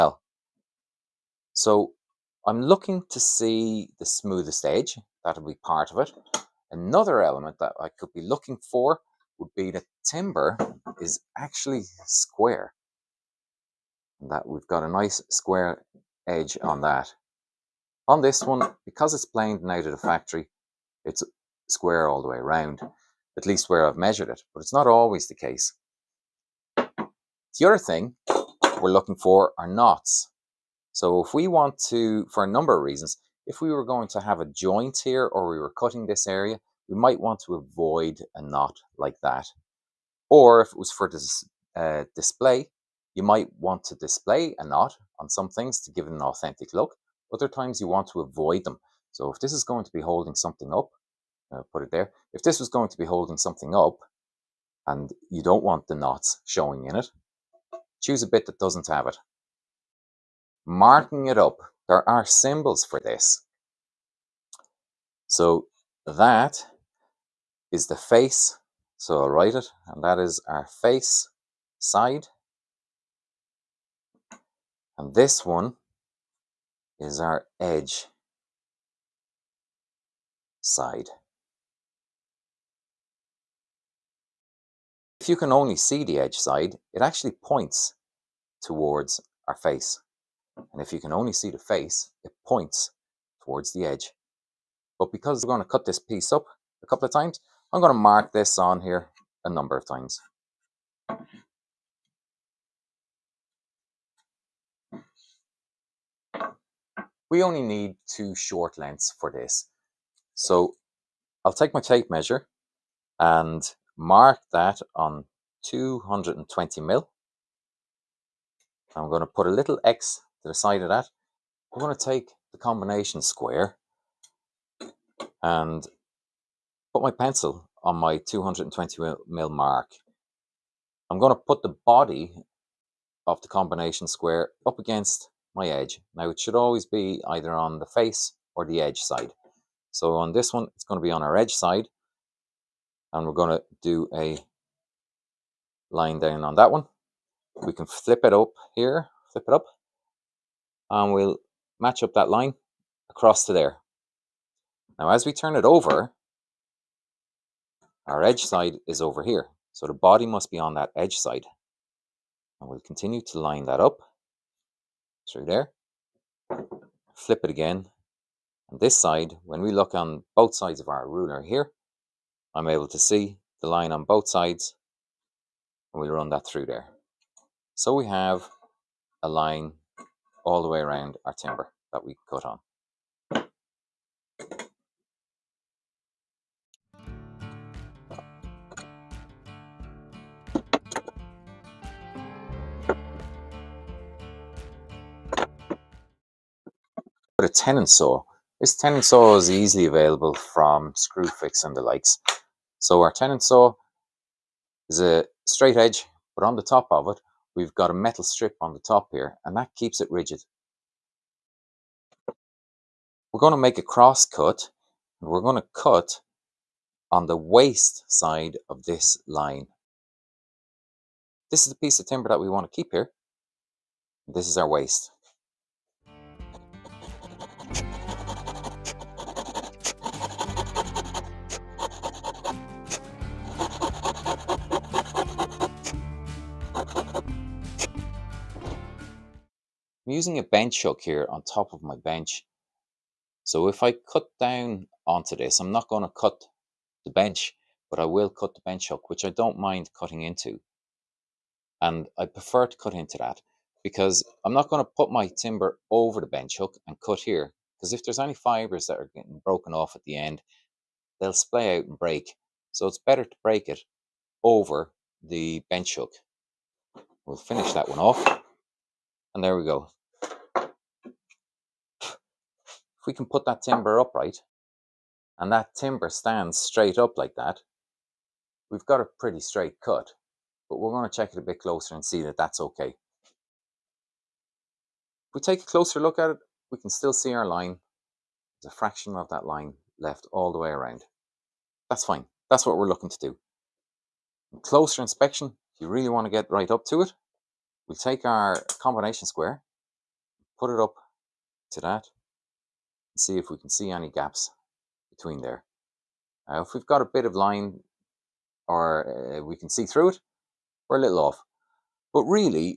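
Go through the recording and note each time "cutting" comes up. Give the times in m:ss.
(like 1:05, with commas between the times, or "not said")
0:35, 4:09.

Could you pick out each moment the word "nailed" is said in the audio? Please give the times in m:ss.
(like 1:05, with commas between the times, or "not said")
not said.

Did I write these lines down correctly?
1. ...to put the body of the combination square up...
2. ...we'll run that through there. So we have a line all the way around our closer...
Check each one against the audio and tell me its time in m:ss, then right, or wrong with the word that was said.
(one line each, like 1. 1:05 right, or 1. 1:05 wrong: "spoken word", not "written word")
1. 2:11 right
2. 2:56 wrong: "timber", not "closer".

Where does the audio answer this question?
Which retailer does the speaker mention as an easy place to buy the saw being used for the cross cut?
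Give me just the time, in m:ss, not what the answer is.
3:20.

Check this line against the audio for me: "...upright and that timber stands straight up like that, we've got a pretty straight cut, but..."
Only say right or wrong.
right.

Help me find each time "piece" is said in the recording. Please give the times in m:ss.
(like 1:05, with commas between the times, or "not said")
1:35, 3:41.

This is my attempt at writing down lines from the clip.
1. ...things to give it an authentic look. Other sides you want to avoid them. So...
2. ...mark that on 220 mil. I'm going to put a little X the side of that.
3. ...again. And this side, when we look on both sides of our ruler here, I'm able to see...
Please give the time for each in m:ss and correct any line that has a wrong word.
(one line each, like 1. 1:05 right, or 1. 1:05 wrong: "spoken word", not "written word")
1. 0:45 wrong: "times", not "sides"
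2. 1:53 right
3. 2:47 right.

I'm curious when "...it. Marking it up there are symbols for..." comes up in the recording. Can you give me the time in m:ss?
0:59.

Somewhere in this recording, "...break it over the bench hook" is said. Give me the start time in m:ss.
4:23.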